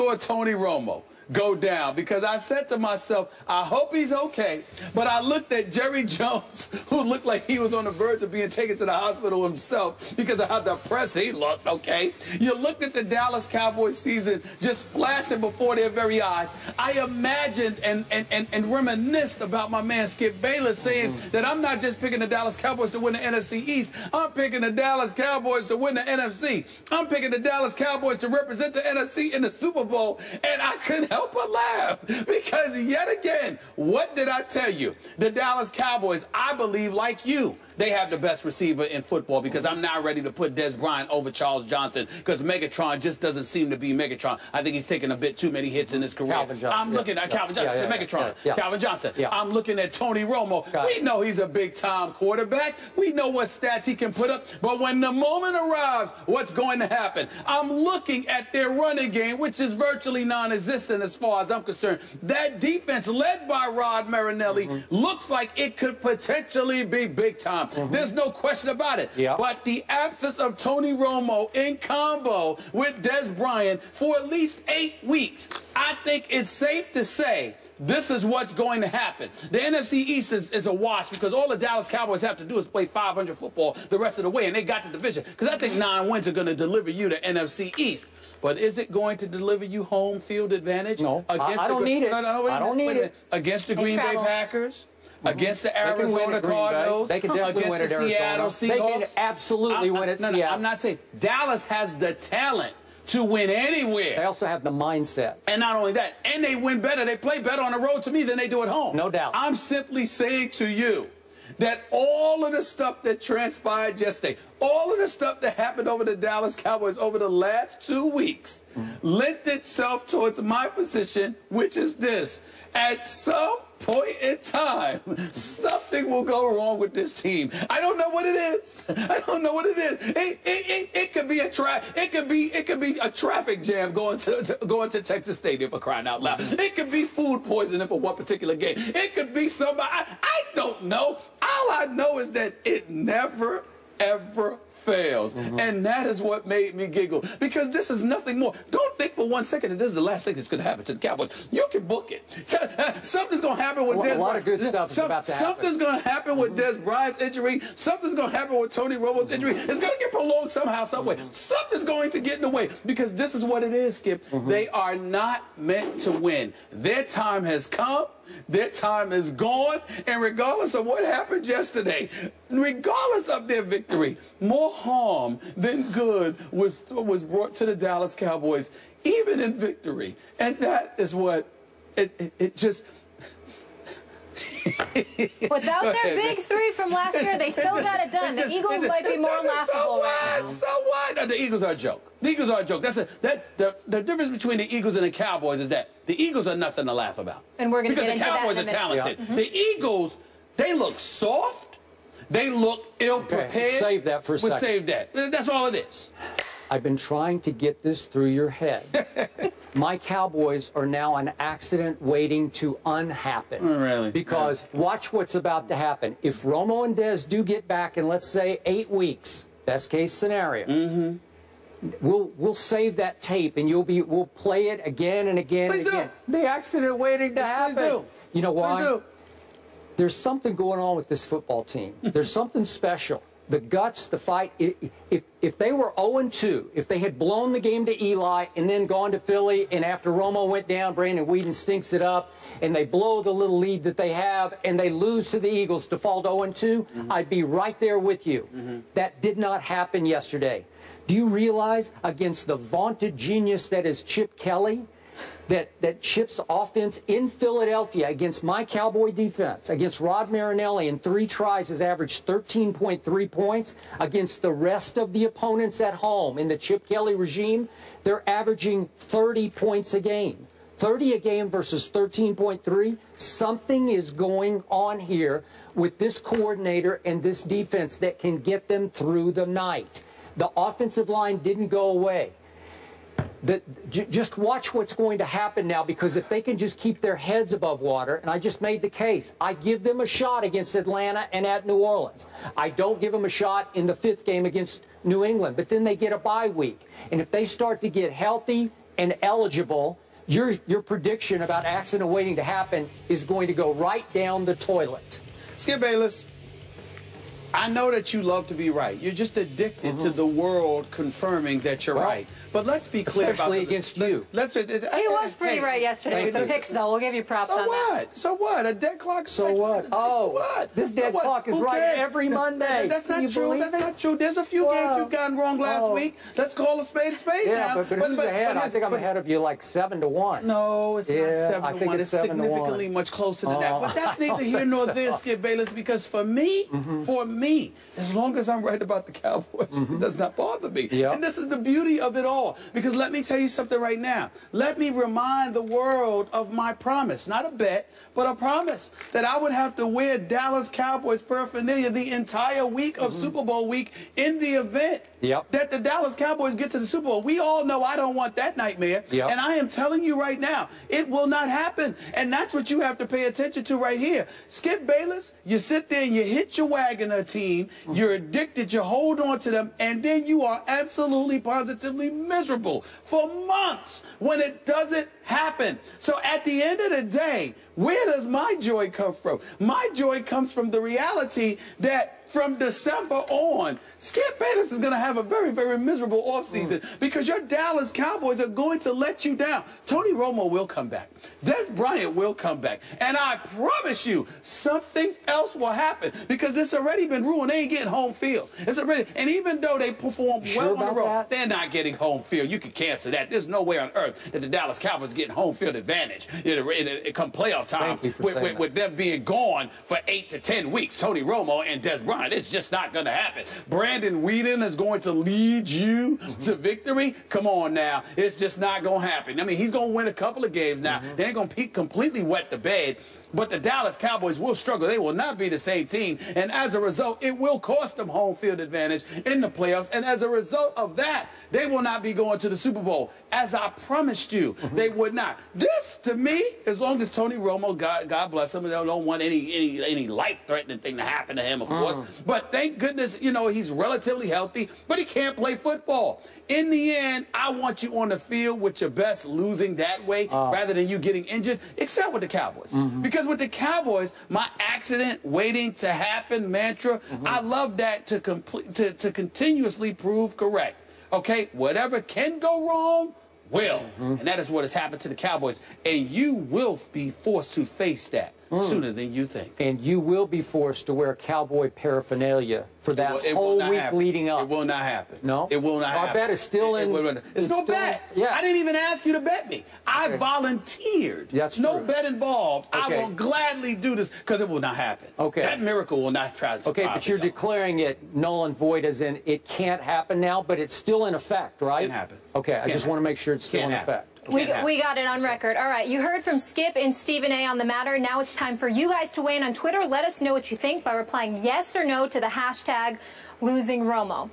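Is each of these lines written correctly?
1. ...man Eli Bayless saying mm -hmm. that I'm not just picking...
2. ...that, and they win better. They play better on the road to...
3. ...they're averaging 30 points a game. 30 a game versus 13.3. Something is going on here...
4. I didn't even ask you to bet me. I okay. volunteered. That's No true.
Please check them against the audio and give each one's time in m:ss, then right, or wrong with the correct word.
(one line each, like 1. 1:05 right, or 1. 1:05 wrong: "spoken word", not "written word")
1. 0:19 wrong: "Skip", not "Eli"
2. 1:45 right
3. 4:28 right
4. 7:58 right.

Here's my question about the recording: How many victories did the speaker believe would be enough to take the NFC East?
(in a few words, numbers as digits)
9.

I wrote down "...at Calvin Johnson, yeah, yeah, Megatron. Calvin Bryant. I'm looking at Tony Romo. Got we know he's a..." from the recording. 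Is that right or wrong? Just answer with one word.
wrong.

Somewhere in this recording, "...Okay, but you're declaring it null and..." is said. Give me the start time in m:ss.
8:06.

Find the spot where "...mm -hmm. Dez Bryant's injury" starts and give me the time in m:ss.
2:36.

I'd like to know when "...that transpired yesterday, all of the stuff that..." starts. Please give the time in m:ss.
1:53.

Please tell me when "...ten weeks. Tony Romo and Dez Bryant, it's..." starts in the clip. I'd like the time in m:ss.
6:50.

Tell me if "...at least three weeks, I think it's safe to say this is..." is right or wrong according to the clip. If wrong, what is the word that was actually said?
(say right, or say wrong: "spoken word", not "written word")
wrong: "eight", not "three".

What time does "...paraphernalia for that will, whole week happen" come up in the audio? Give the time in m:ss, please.
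7:51.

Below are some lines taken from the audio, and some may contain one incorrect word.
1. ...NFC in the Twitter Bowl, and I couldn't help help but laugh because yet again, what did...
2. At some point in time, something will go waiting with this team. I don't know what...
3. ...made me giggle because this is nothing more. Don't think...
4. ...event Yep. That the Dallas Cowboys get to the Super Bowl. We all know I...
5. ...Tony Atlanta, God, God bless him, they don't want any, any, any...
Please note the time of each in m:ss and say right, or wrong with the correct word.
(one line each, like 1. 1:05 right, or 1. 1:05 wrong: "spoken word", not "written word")
1. 0:28 wrong: "Super", not "Twitter"
2. 2:02 wrong: "wrong", not "waiting"
3. 2:26 right
4. 5:54 right
5. 7:17 wrong: "Romo", not "Atlanta".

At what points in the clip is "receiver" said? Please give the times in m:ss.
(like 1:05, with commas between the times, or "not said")
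0:38.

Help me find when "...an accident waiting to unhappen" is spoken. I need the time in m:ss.
3:31.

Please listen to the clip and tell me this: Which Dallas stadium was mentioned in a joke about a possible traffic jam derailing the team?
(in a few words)
Texas Stadium.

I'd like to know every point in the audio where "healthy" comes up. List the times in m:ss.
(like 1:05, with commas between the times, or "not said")
4:58, 7:24.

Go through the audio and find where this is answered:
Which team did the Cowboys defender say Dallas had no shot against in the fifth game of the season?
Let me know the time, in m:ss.
4:55.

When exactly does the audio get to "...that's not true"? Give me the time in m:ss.
5:22.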